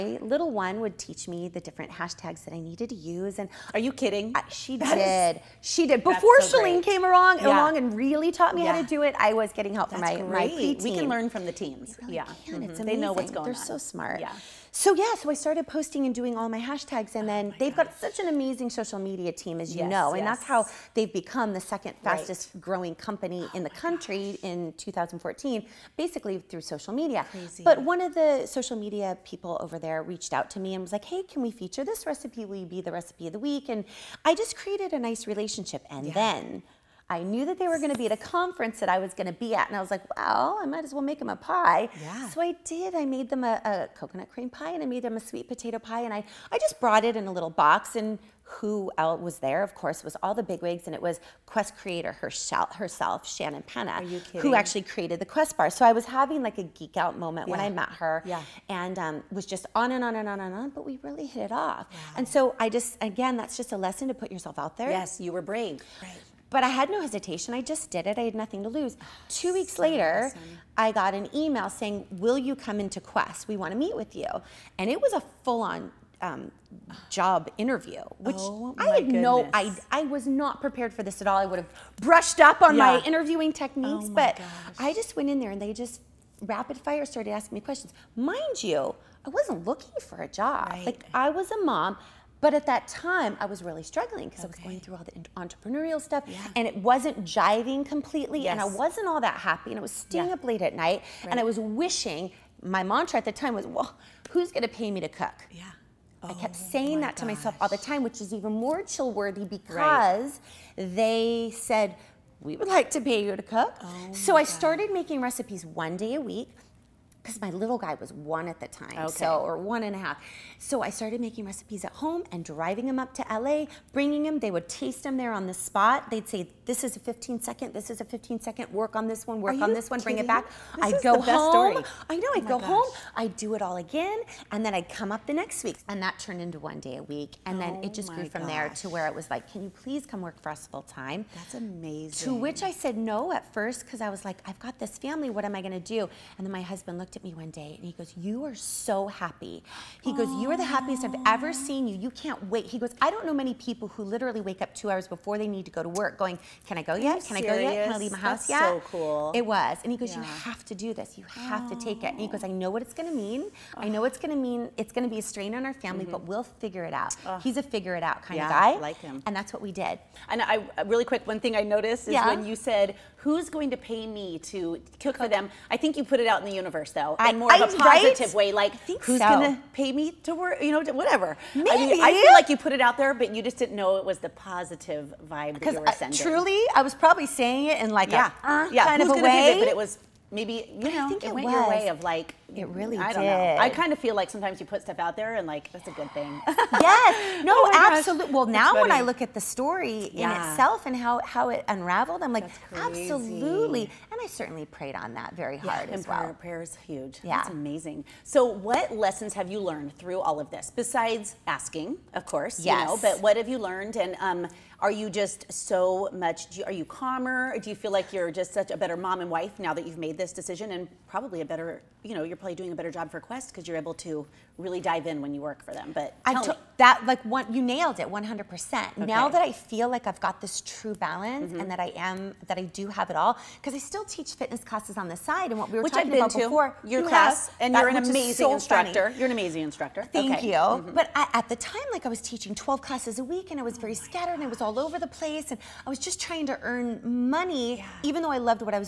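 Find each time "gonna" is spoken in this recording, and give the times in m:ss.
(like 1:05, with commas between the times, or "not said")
2:59.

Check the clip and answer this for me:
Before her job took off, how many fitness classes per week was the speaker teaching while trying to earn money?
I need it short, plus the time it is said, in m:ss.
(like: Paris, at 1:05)
12, at 4:02.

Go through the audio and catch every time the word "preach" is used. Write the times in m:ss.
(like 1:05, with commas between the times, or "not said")
not said.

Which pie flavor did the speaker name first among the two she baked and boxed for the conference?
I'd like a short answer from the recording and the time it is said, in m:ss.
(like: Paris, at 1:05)
Coconut cream, at 0:43.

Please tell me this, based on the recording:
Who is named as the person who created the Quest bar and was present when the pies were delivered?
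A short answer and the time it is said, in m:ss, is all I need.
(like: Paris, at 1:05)
Shannon Penna, at 0:53.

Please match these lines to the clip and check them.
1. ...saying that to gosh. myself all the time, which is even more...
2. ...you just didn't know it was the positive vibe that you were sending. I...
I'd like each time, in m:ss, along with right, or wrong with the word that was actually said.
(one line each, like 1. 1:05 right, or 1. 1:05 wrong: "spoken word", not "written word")
1. 1:46 right
2. 3:03 right.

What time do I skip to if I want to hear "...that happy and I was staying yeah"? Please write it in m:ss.
1:39.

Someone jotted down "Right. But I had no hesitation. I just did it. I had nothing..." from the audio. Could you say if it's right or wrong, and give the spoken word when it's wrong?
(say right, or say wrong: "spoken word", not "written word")
right.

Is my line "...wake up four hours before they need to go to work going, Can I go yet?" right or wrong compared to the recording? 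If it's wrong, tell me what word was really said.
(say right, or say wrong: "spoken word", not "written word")
wrong: "two", not "four".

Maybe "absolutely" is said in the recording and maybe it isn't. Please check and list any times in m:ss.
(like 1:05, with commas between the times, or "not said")
3:17, 3:22.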